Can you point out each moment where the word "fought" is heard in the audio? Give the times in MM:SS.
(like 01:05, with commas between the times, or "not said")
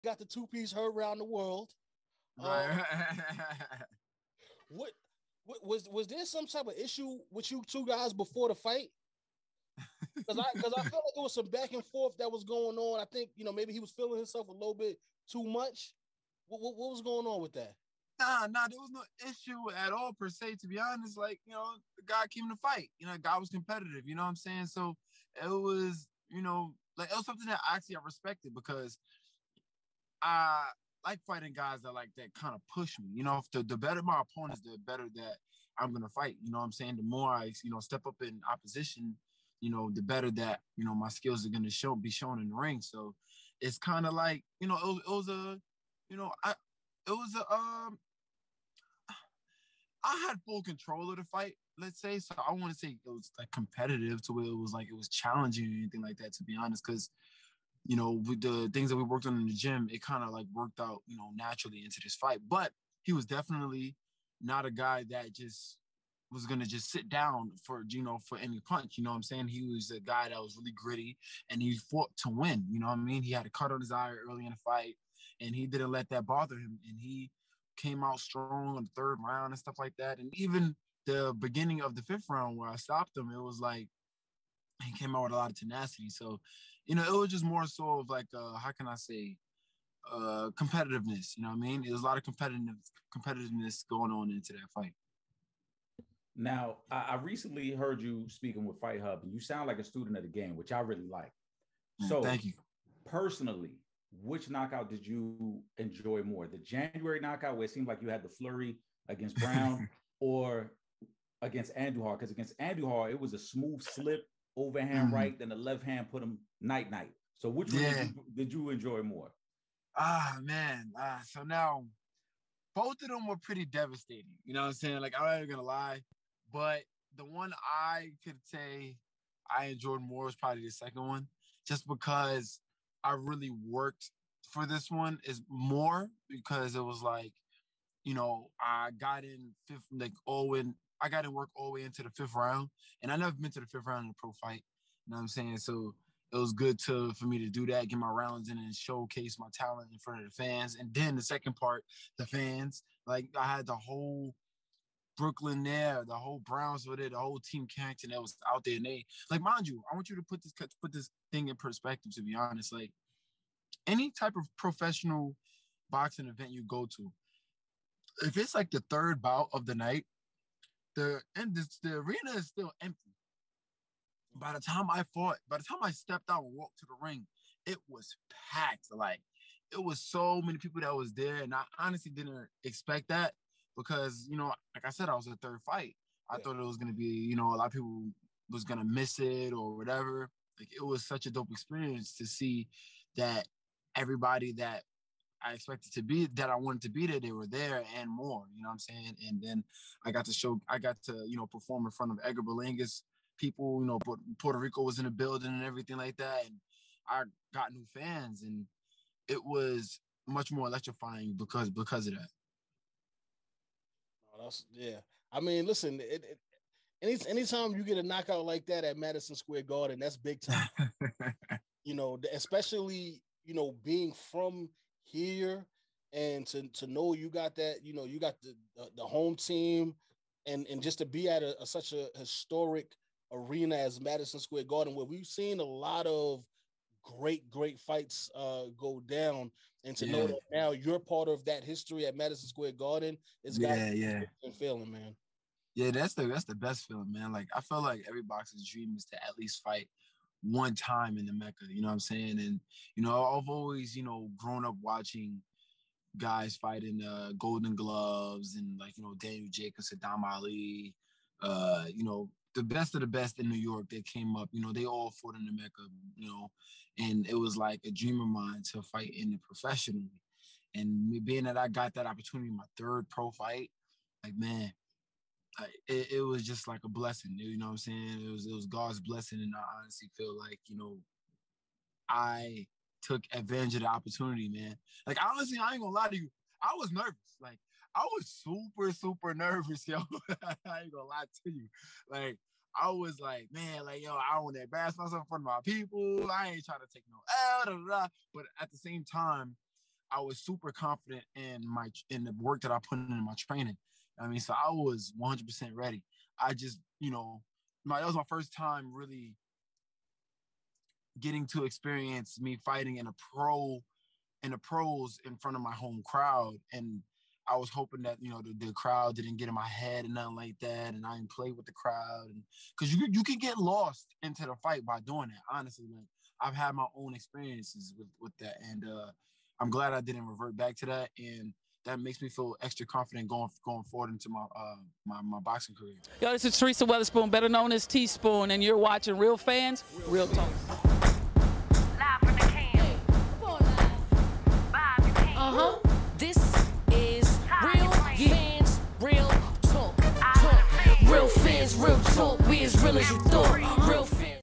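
01:11, 02:55, 04:25.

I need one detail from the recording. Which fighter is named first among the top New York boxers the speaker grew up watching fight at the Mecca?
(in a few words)
Daniel Jacobs.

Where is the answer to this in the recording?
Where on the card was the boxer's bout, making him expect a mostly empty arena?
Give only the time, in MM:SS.
03:05.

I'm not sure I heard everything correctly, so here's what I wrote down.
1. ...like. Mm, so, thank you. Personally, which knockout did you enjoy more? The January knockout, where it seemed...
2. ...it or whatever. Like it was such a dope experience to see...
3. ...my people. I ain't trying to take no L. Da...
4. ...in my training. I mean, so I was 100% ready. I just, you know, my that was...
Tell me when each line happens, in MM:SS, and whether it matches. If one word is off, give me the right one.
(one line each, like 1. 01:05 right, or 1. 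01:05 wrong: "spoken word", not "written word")
1. 01:41 right
2. 03:09 right
3. 04:55 right
4. 05:02 right.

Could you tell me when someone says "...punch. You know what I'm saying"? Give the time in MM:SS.
01:08.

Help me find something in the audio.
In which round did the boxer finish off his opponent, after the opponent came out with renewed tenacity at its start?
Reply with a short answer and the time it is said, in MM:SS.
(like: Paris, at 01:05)
5th, at 01:22.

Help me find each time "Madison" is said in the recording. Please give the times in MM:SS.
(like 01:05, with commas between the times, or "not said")
03:38, 03:54, 04:02.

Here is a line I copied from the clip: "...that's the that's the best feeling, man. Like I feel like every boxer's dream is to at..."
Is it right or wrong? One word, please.
right.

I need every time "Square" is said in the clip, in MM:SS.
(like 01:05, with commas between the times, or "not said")
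03:39, 03:54, 04:02.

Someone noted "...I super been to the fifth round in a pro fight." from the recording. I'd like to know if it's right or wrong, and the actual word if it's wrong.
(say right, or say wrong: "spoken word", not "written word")
wrong: "never", not "super".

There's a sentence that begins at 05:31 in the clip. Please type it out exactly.
And that makes me feel extra confident going going forward into my uh, my, my boxing career.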